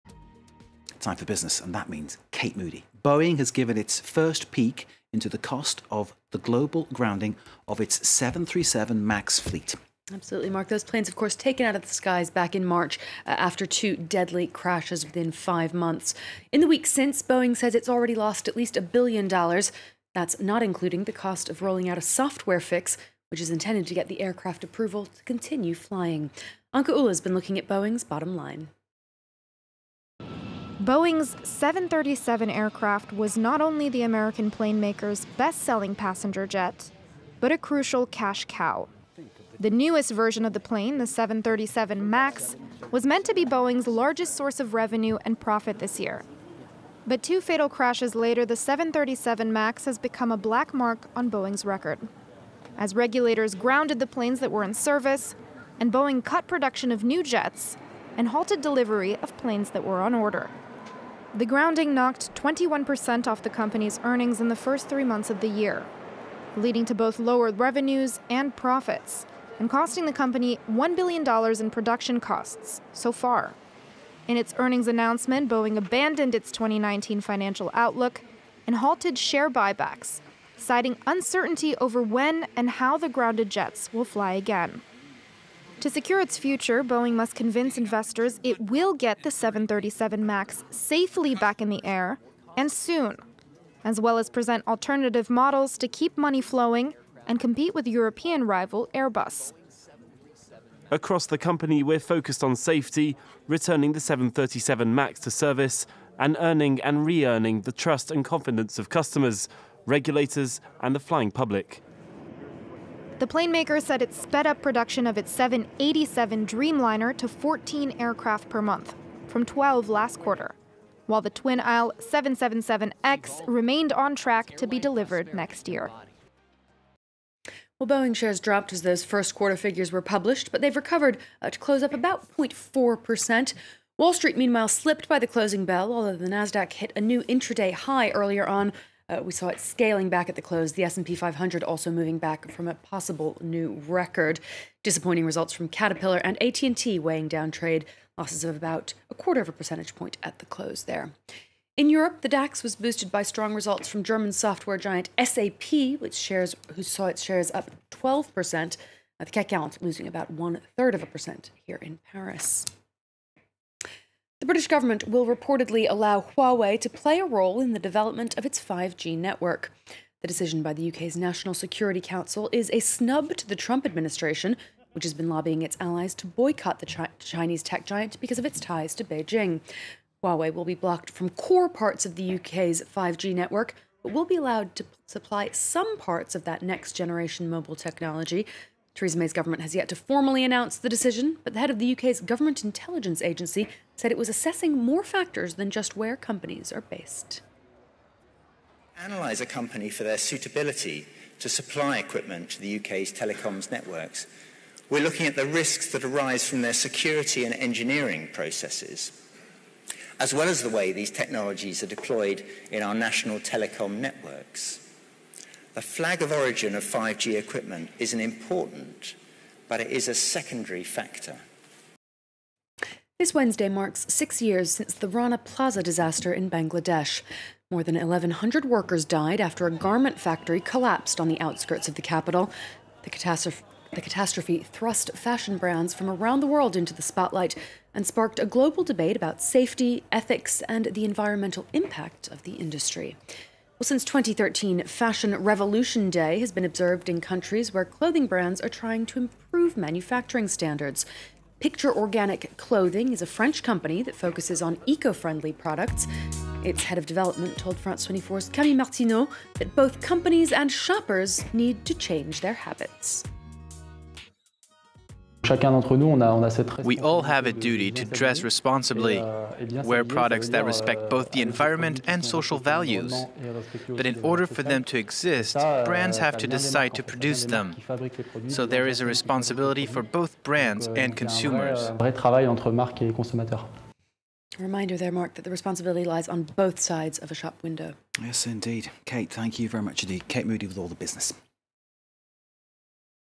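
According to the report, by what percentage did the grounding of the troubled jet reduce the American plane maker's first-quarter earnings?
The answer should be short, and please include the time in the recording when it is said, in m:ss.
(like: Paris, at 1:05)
21%, at 1:02.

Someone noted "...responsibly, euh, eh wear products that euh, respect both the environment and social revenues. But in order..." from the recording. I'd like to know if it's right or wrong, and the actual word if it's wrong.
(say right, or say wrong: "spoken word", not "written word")
wrong: "values", not "revenues".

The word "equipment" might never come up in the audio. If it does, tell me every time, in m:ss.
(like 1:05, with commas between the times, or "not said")
3:21, 3:37.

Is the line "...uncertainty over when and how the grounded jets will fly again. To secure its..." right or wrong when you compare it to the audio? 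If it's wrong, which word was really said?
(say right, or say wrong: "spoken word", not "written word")
right.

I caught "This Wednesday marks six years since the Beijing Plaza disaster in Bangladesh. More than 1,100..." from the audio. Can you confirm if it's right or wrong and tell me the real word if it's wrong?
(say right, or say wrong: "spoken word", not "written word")
wrong: "Rana", not "Beijing".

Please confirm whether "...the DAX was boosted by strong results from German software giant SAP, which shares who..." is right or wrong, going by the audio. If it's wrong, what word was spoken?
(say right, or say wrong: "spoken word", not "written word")
right.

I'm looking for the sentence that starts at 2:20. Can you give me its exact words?
The S&P 500 also moving back from a possible new record.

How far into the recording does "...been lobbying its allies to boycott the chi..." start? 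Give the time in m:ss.
2:55.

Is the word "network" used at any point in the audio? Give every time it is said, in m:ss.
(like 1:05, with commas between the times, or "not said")
2:49, 3:03, 3:23, 3:33.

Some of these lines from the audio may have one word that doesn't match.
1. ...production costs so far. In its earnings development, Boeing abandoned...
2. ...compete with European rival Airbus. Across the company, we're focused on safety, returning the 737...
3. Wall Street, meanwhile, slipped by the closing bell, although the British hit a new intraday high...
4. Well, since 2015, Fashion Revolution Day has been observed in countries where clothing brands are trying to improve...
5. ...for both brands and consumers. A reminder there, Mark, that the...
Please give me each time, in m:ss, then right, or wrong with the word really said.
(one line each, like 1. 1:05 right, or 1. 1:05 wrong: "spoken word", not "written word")
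1. 1:11 wrong: "announcement", not "development"
2. 1:37 right
3. 2:13 wrong: "NASDAQ", not "British"
4. 4:03 wrong: "2013", not "2015"
5. 4:39 right.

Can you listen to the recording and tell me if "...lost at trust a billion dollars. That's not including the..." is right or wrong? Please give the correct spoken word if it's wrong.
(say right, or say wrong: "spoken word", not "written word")
wrong: "least", not "trust".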